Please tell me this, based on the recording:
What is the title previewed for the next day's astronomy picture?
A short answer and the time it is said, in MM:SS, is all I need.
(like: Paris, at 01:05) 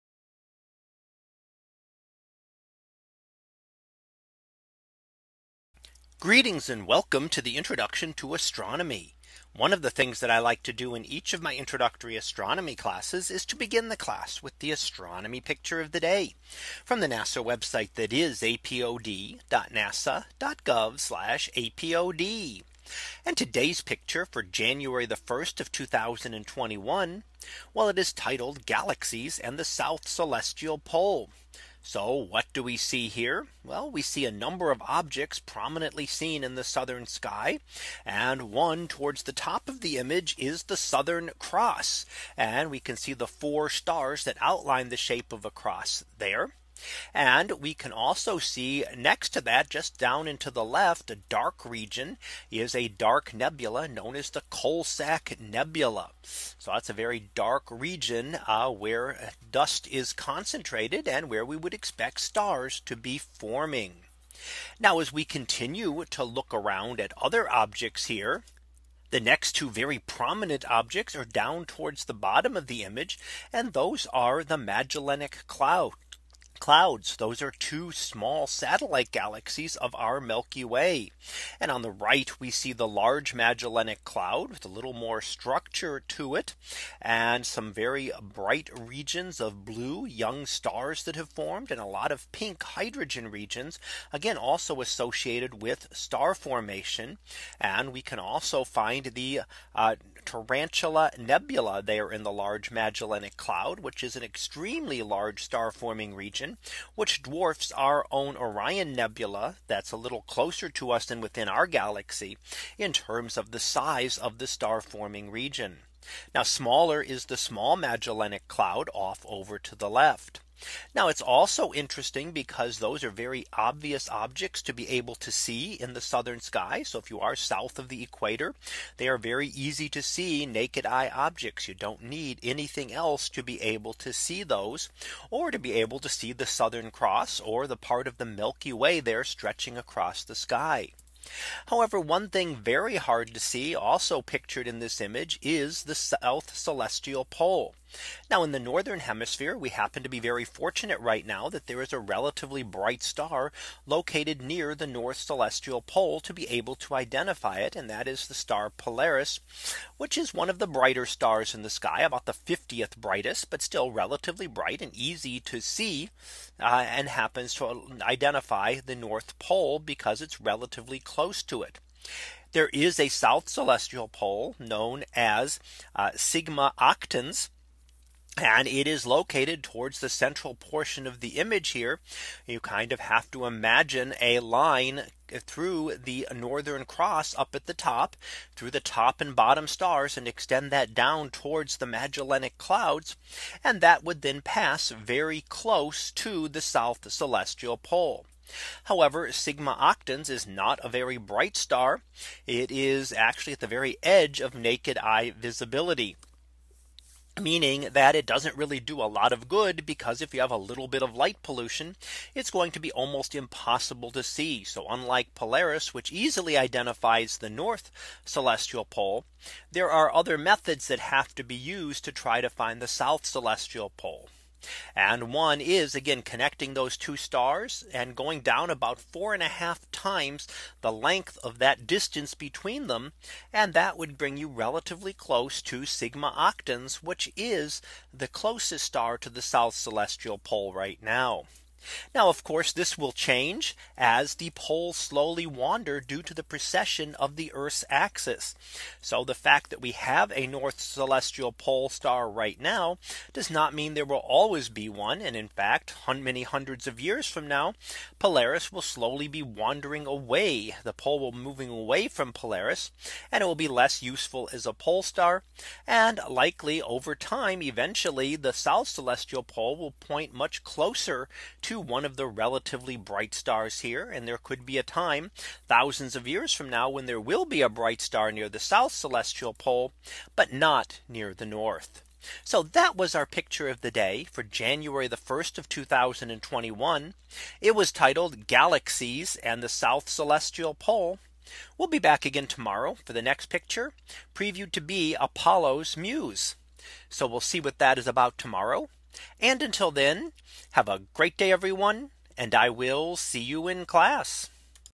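Apollo's Muse, at 04:55.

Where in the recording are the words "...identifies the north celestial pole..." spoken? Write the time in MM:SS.
03:36.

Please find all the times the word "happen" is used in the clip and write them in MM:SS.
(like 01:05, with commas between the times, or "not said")
02:29, 02:47.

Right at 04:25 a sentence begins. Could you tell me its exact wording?
And likely over time, eventually, the South Celestial Pole will point much closer to one of the relatively bright stars here.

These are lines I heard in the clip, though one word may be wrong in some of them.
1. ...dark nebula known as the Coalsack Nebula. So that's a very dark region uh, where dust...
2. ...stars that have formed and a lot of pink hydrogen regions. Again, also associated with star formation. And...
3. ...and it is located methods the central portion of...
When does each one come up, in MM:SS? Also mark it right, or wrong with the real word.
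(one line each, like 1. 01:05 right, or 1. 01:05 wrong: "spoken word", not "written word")
1. 00:52 right
2. 01:30 right
3. 02:58 wrong: "towards", not "methods".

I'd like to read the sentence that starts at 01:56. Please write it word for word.
Now smaller is the small Magellanic cloud off over to the left.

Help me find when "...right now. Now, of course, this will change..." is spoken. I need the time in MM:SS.
04:00.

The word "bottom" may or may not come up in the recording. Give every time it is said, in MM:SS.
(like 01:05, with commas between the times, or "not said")
01:12, 03:09.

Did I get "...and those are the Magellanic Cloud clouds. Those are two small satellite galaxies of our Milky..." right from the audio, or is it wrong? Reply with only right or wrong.
right.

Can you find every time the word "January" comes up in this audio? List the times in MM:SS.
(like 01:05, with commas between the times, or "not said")
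00:24, 04:44.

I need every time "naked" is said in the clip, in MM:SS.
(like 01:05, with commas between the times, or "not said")
02:10, 03:24.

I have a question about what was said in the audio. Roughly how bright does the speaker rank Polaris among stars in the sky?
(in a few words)
50th brightest.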